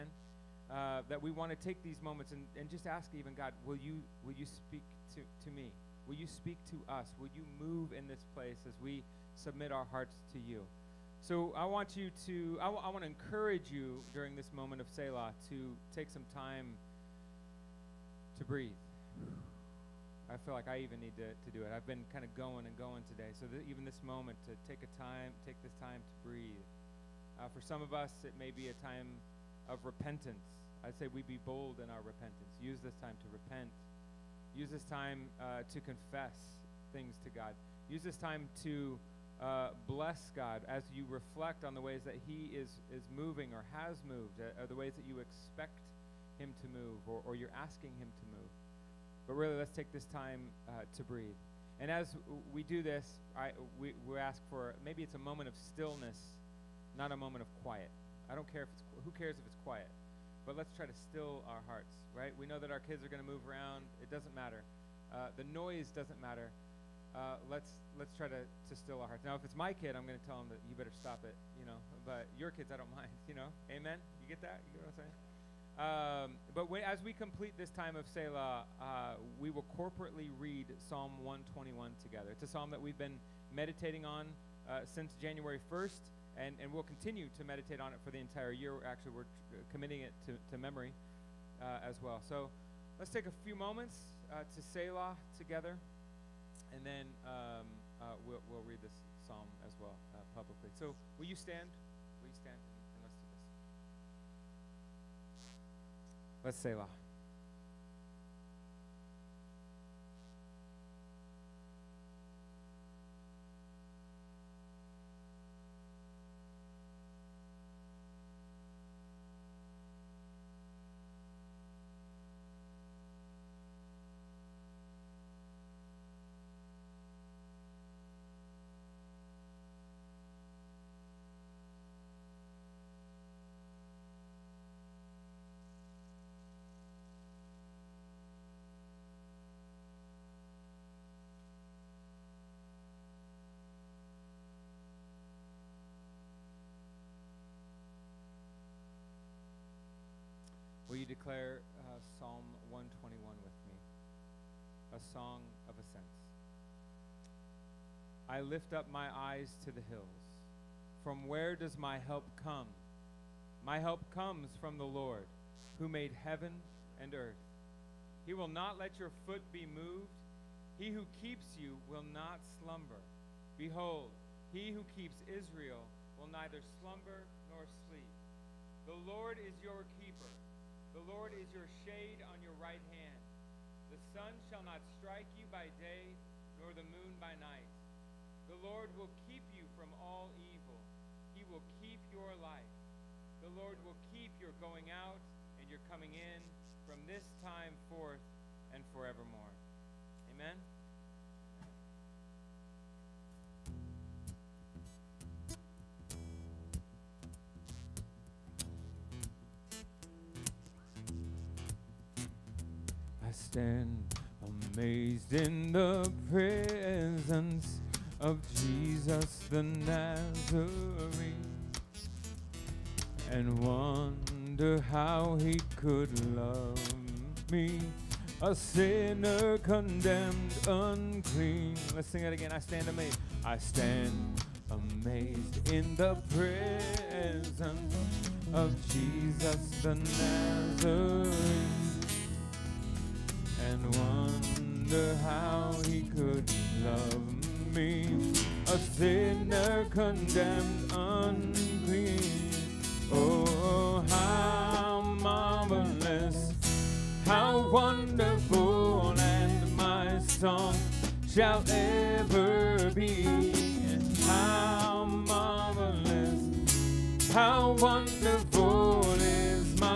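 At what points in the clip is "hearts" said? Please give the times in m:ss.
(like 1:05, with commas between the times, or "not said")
0:09, 1:01, 1:09.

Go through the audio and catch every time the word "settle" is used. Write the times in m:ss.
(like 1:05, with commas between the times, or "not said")
not said.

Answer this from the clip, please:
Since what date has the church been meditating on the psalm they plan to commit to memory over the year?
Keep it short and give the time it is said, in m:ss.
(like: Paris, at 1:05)
January 1st, at 1:25.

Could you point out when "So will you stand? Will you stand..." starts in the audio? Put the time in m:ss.
1:40.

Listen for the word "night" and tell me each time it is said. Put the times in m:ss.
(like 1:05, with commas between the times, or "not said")
3:07.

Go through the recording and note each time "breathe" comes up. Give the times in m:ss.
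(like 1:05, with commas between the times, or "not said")
0:18, 0:26, 0:51.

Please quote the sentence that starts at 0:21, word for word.
I've been kind of going and going today.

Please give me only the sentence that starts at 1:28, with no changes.
Actually, we're uh, committing it to, to memory uh, as well.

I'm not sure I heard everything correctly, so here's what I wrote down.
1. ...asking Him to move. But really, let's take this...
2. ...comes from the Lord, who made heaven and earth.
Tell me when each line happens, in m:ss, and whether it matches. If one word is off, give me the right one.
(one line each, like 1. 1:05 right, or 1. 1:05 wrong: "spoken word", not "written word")
1. 0:47 right
2. 2:44 right.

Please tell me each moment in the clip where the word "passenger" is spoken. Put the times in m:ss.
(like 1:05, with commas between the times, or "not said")
not said.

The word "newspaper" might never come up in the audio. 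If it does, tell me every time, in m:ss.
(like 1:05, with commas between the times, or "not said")
not said.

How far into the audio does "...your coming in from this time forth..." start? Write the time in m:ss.
3:15.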